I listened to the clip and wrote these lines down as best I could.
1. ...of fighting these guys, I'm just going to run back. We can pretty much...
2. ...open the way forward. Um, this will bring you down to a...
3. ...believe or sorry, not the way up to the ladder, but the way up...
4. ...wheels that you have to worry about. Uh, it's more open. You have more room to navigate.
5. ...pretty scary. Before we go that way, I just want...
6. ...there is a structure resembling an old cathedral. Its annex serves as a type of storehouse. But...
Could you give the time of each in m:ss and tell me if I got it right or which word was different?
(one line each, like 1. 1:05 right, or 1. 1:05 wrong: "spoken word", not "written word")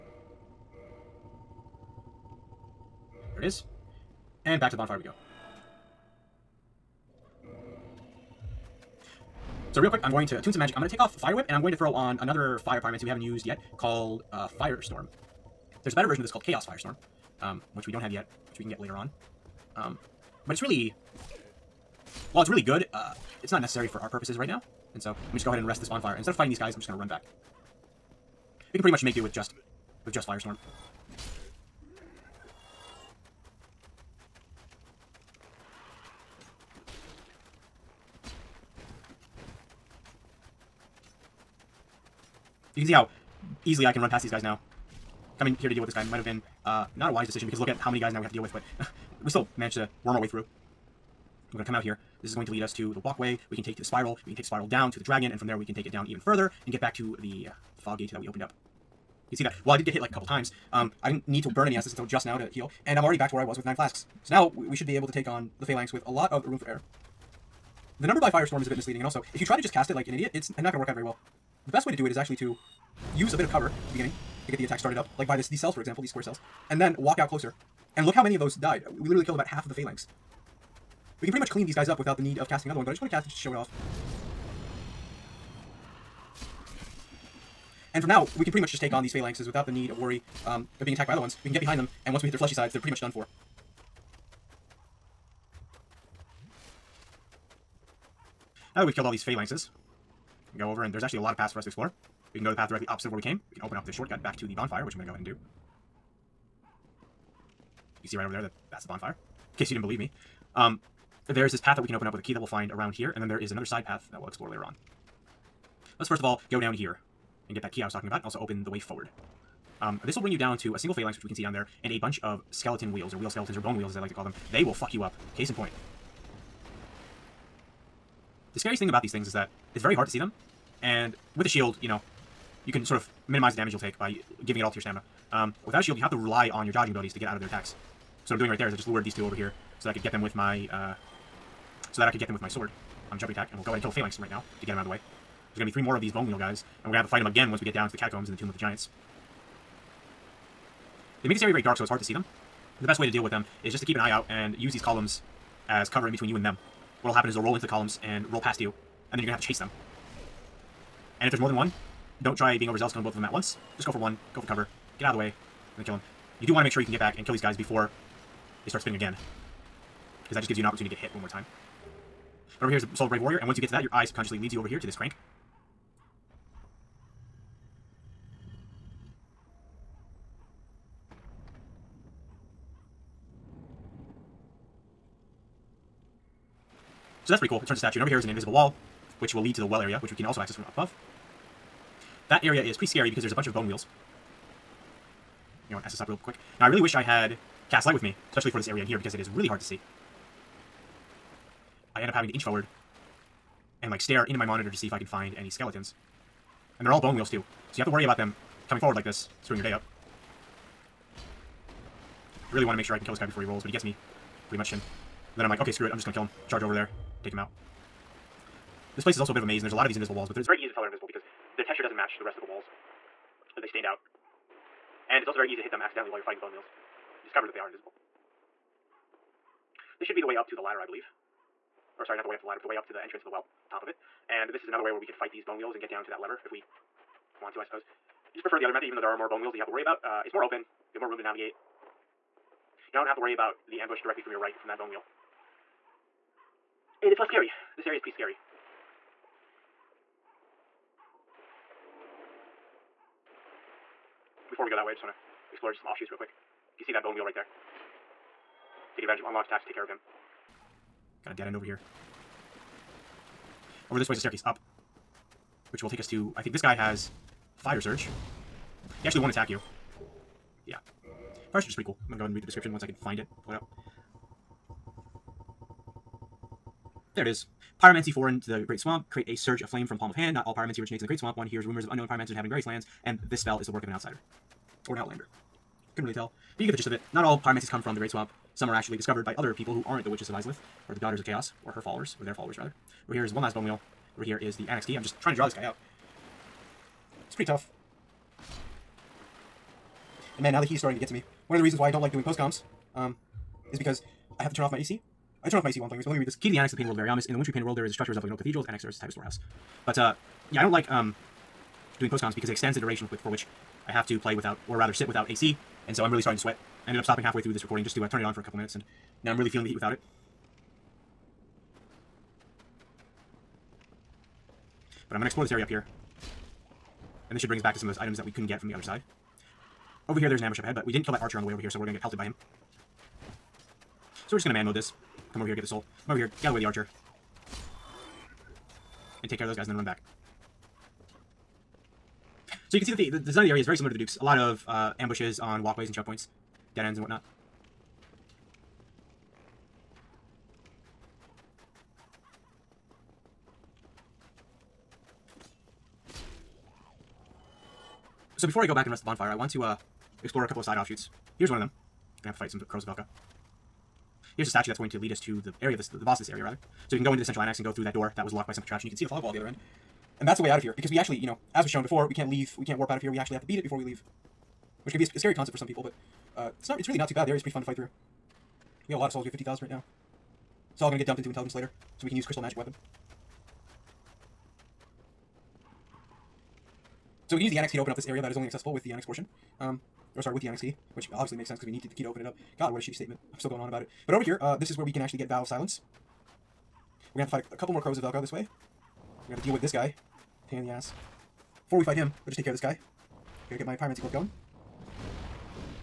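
1. 0:26 right
2. 1:58 right
3. 3:50 right
4. 3:59 right
5. 4:07 right
6. 5:07 right.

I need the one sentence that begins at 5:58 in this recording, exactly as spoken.
So before I go back and rest the bonfire, I want to uh, explore a couple of side offshoots.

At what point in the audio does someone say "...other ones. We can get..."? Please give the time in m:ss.
1:31.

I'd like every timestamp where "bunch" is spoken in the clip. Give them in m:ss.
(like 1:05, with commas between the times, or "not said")
2:01, 3:13.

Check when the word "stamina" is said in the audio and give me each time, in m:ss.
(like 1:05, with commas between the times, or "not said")
2:14.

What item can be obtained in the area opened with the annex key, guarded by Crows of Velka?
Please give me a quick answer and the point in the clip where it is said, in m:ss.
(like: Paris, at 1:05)
Vow of Silence, at 6:35.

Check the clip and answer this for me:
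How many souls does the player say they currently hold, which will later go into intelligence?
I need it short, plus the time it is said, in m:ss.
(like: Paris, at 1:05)
50,000, at 6:19.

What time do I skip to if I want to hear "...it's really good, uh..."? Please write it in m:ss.
0:22.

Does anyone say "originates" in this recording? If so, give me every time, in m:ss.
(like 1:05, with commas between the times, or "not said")
4:40.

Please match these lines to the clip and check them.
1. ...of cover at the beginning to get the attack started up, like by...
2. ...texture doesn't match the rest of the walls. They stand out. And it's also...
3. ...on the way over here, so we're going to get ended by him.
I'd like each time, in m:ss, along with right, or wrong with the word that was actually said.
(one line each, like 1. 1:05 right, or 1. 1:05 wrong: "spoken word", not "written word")
1. 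1:13 right
2. 3:41 right
3. 5:31 wrong: "pelted", not "ended".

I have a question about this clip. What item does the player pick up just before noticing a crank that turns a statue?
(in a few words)
Soul of a Brave Warrior.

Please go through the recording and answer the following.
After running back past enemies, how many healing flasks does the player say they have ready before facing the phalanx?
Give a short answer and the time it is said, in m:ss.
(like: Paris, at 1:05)
9, at 1:03.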